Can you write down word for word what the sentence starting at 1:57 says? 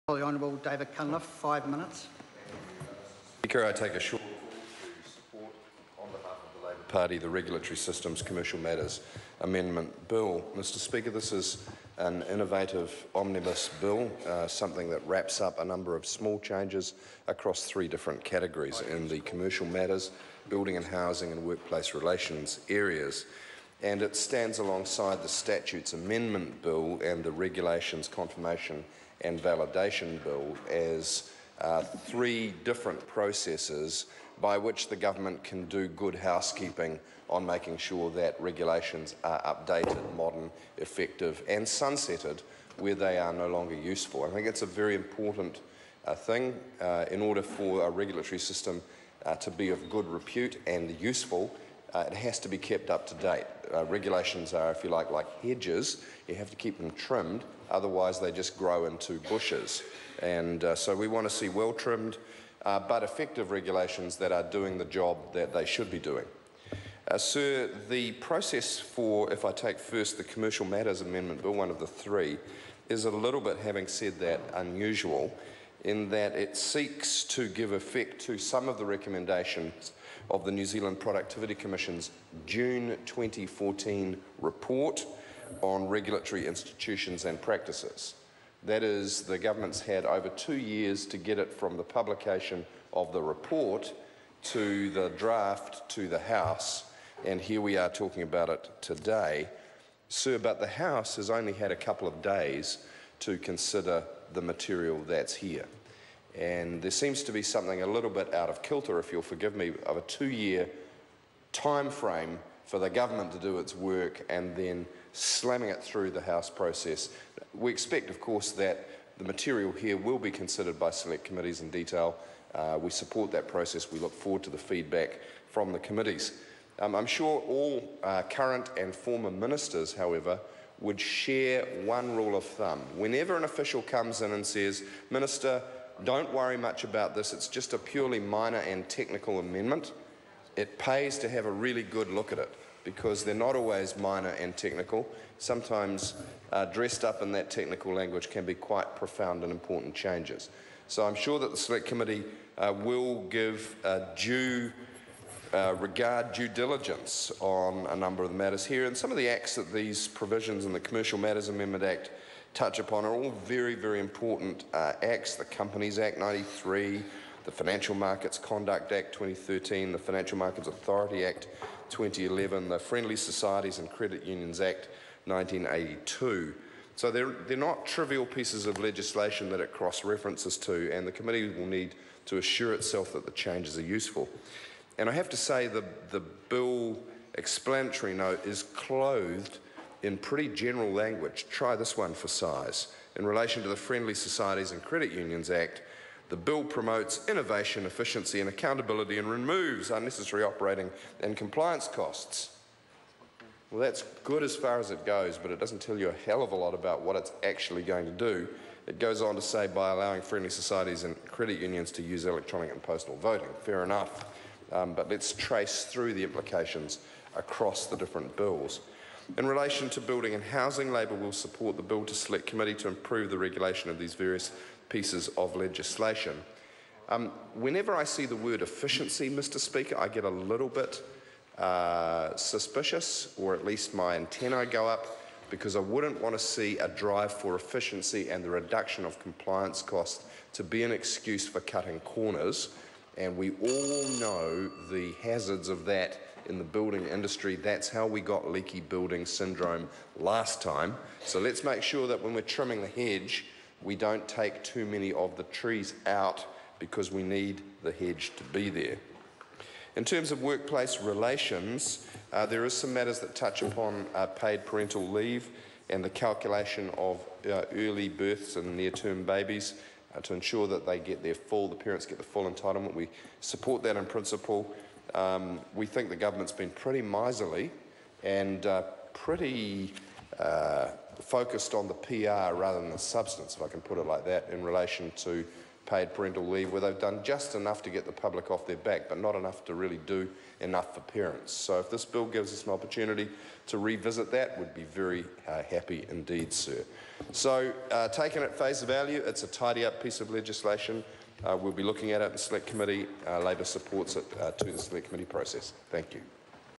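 We expect, of course, that the material here will be considered by select committees in detail.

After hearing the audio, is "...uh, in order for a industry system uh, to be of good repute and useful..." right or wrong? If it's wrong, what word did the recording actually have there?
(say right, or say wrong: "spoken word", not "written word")
wrong: "regulatory", not "industry".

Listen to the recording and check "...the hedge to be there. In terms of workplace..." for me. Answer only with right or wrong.
right.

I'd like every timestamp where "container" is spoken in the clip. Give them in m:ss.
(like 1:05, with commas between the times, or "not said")
not said.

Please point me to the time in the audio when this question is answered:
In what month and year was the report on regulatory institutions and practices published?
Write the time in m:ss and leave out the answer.
1:22.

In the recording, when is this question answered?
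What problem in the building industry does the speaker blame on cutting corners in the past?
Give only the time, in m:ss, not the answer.
4:08.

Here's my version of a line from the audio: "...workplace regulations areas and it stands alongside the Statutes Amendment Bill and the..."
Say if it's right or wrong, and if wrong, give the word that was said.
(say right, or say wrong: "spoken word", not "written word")
wrong: "relations", not "regulations".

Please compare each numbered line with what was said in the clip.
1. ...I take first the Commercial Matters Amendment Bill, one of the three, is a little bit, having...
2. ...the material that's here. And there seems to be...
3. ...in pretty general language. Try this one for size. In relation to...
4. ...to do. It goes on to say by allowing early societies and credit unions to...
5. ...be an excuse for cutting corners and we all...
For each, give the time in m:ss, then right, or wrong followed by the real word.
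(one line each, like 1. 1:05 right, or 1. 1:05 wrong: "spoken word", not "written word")
1. 1:09 right
2. 1:44 right
3. 3:10 right
4. 3:28 wrong: "friendly", not "early"
5. 4:00 right.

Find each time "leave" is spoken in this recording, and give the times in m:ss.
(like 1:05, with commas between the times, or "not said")
4:25, 4:46.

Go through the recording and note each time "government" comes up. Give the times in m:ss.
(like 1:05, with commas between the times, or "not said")
0:34, 1:29, 1:52, 4:36.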